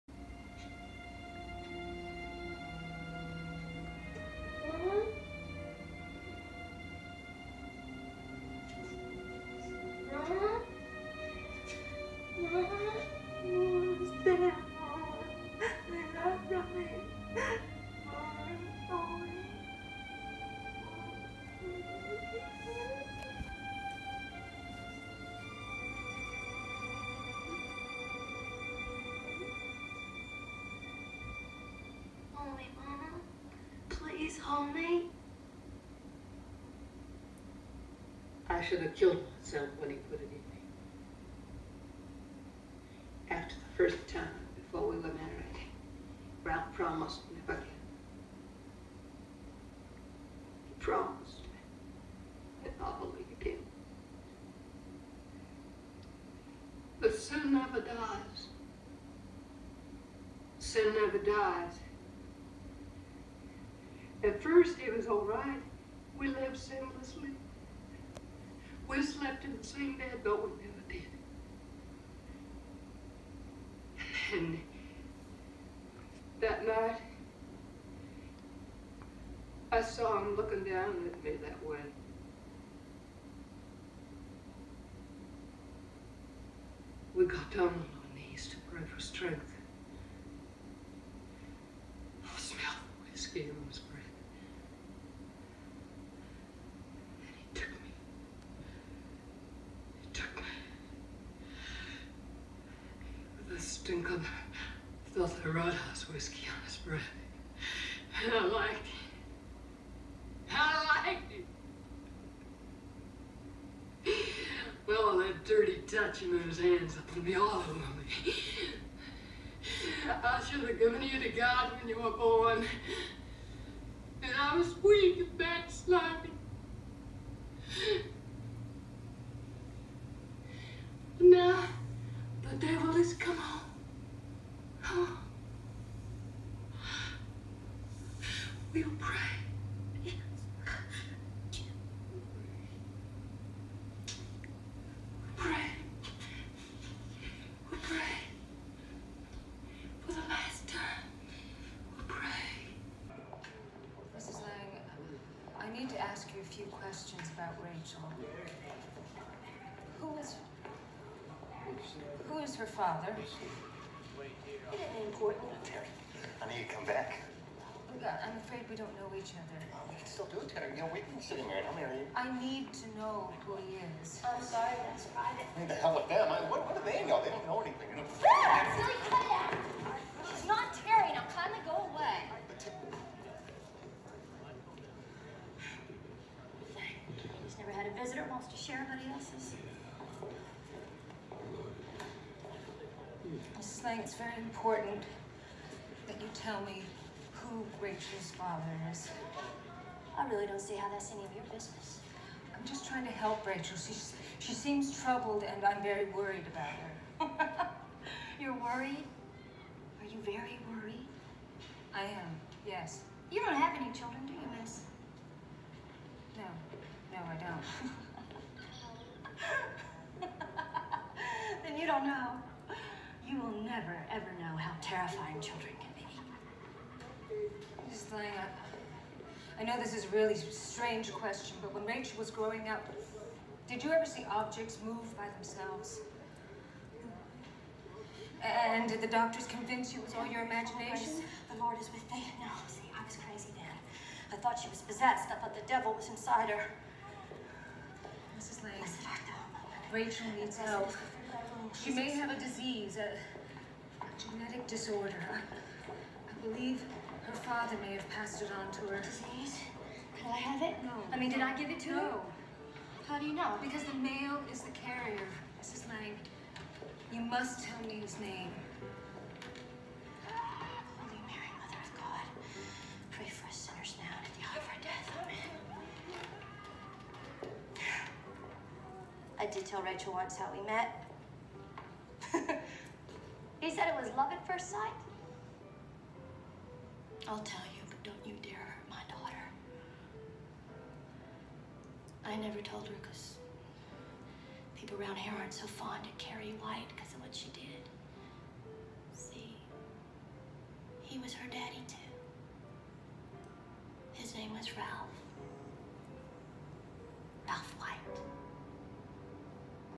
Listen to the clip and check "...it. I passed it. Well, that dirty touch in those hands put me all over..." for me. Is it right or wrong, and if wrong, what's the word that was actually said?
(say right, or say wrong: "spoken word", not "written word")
wrong: "liked", not "passed".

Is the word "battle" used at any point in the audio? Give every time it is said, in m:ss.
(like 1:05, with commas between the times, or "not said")
not said.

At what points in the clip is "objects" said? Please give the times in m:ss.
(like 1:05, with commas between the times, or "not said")
3:54.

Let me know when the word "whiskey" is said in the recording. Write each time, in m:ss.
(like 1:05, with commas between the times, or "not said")
1:33, 1:46.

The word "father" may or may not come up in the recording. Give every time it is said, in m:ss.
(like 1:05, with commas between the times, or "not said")
2:42, 3:18, 4:17.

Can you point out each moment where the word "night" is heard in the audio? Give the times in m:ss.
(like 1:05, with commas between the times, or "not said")
1:16.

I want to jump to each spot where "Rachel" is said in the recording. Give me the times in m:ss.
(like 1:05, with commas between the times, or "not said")
2:37, 3:17, 3:23, 3:51, 4:09, 4:39.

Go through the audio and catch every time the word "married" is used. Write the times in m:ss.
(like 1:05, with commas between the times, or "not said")
0:45, 2:51.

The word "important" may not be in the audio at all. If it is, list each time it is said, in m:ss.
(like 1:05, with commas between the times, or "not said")
2:45, 3:14.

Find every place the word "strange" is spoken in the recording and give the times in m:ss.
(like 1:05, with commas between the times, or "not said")
3:50.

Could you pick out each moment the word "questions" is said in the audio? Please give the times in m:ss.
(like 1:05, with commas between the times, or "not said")
2:36, 3:51.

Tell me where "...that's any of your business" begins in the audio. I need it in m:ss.
3:20.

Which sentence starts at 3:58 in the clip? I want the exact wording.
And did the doctors convince you it was all your imagination?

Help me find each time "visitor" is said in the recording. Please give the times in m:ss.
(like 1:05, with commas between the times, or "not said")
3:08.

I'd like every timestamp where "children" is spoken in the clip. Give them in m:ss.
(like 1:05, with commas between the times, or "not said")
3:33, 3:45.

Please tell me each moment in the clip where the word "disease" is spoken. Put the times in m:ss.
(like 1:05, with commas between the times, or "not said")
4:12, 4:19.